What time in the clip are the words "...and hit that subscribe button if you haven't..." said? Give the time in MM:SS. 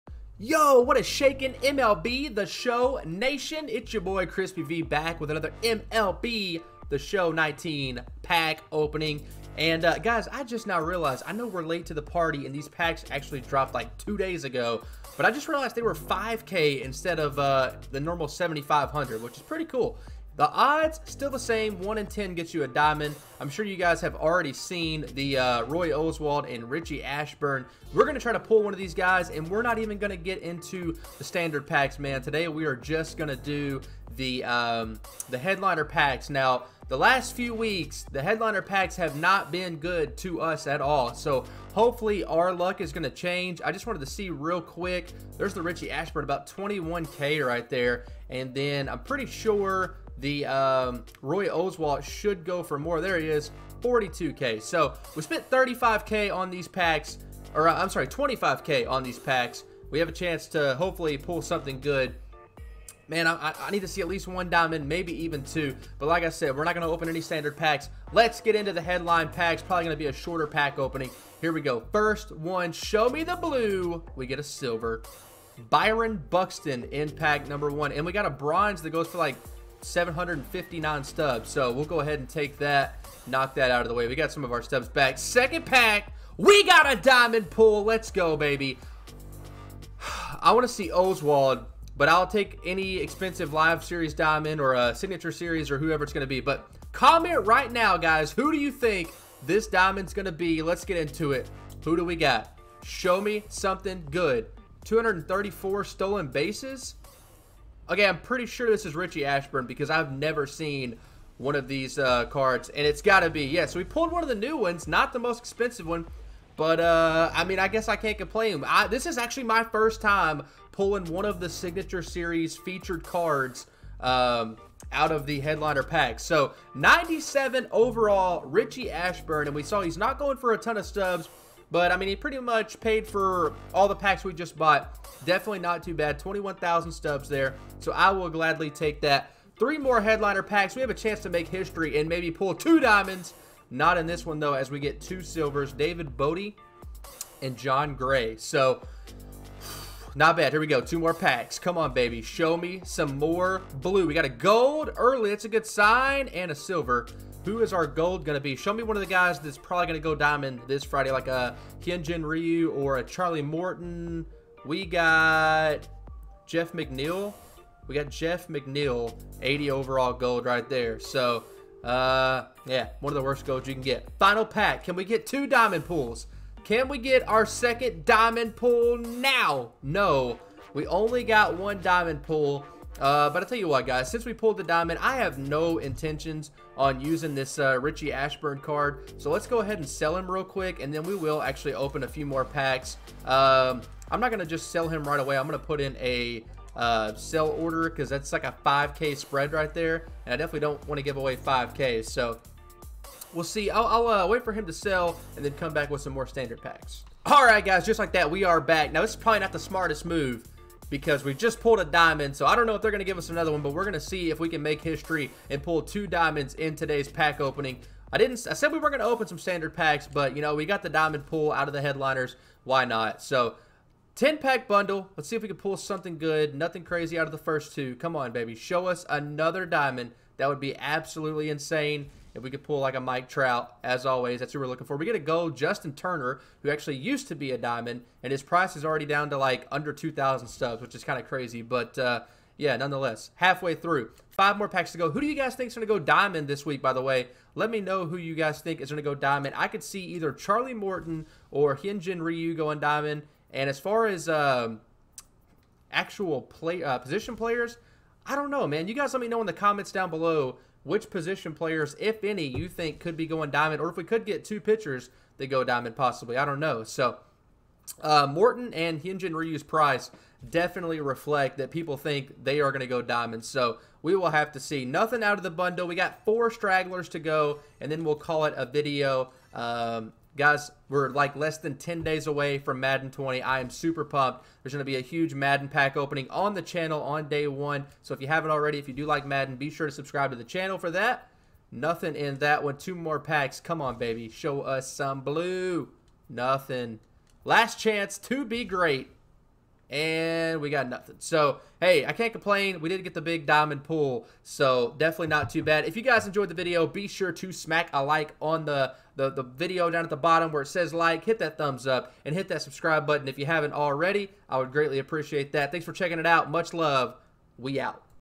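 05:12.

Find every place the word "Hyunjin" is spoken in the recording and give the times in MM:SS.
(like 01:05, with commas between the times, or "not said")
02:41, 04:11, 04:29.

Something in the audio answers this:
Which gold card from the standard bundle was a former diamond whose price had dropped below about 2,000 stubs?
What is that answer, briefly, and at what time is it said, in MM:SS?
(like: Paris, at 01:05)
Justin Turner, at 03:55.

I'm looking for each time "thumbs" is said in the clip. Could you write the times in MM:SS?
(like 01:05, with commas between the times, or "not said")
05:11.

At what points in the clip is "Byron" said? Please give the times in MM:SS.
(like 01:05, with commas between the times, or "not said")
01:15.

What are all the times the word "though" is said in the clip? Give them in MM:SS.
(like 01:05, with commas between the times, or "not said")
02:24.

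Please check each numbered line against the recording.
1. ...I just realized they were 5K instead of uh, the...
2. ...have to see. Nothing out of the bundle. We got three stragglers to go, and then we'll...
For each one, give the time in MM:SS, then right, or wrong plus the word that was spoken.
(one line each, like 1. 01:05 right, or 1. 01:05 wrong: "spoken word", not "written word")
1. 00:15 right
2. 04:34 wrong: "four", not "three".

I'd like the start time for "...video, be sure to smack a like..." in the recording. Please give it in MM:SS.
05:06.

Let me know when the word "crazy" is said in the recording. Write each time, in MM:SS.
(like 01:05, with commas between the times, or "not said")
03:46, 04:01.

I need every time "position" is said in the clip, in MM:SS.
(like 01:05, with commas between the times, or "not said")
04:16, 04:21.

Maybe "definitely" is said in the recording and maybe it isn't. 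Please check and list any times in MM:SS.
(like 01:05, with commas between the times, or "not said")
02:15, 03:20, 04:30, 05:04.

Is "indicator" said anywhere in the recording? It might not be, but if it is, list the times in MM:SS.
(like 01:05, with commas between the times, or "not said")
not said.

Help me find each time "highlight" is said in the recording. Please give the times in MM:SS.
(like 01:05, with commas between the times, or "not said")
not said.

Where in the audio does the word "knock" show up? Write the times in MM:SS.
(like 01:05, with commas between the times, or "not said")
01:23.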